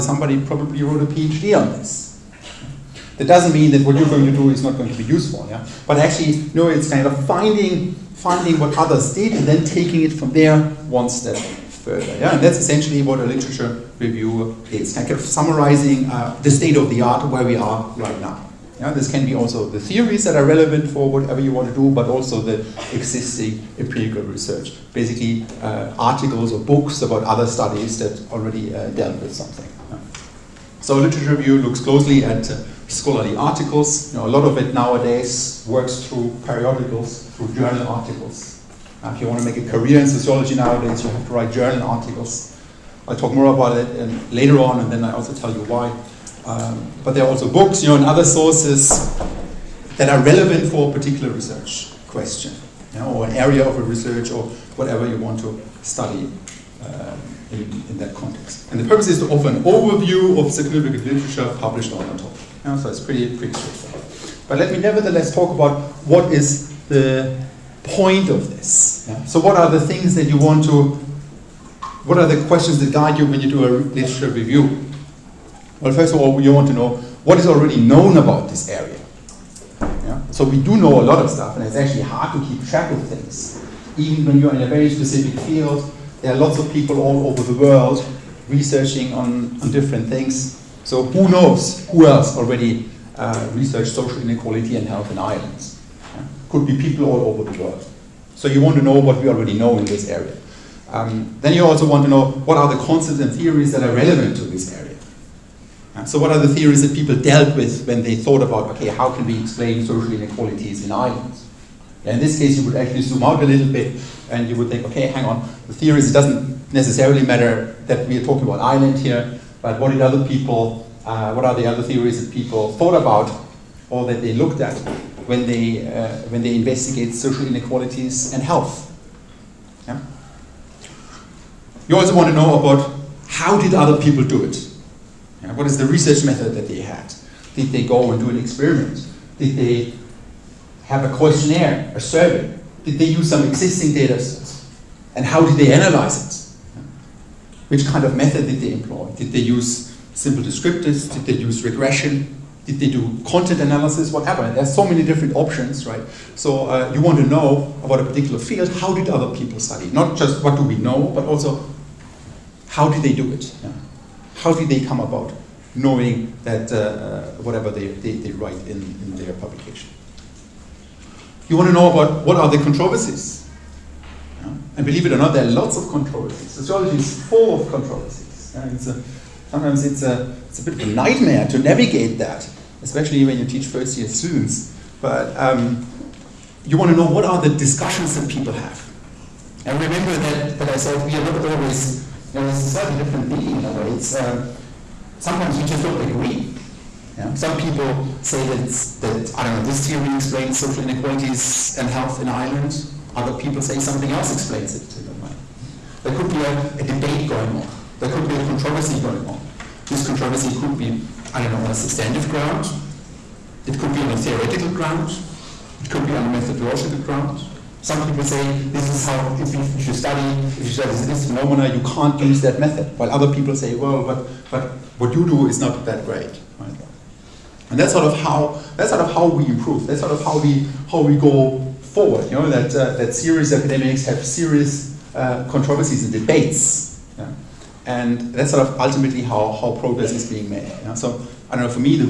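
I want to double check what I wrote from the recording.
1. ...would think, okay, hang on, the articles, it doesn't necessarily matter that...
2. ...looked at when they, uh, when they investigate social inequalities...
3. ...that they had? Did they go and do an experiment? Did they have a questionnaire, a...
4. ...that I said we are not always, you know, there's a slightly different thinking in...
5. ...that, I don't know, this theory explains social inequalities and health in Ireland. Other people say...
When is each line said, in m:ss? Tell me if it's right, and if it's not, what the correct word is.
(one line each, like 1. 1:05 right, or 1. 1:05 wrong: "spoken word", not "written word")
1. 1:54 wrong: "theories", not "articles"
2. 2:04 right
3. 2:16 right
4. 3:10 right
5. 3:19 right.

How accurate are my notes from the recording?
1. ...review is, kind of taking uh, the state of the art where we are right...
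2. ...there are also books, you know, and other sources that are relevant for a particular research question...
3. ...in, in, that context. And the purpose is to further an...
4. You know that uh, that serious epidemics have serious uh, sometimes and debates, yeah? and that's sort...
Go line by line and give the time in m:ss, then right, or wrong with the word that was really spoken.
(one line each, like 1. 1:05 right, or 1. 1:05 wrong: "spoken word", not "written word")
1. 0:13 wrong: "summarizing", not "taking"
2. 0:47 right
3. 0:57 wrong: "offer", not "further"
4. 3:52 wrong: "controversies", not "sometimes".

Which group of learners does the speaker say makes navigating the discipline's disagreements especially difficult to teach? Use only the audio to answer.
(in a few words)
First year students.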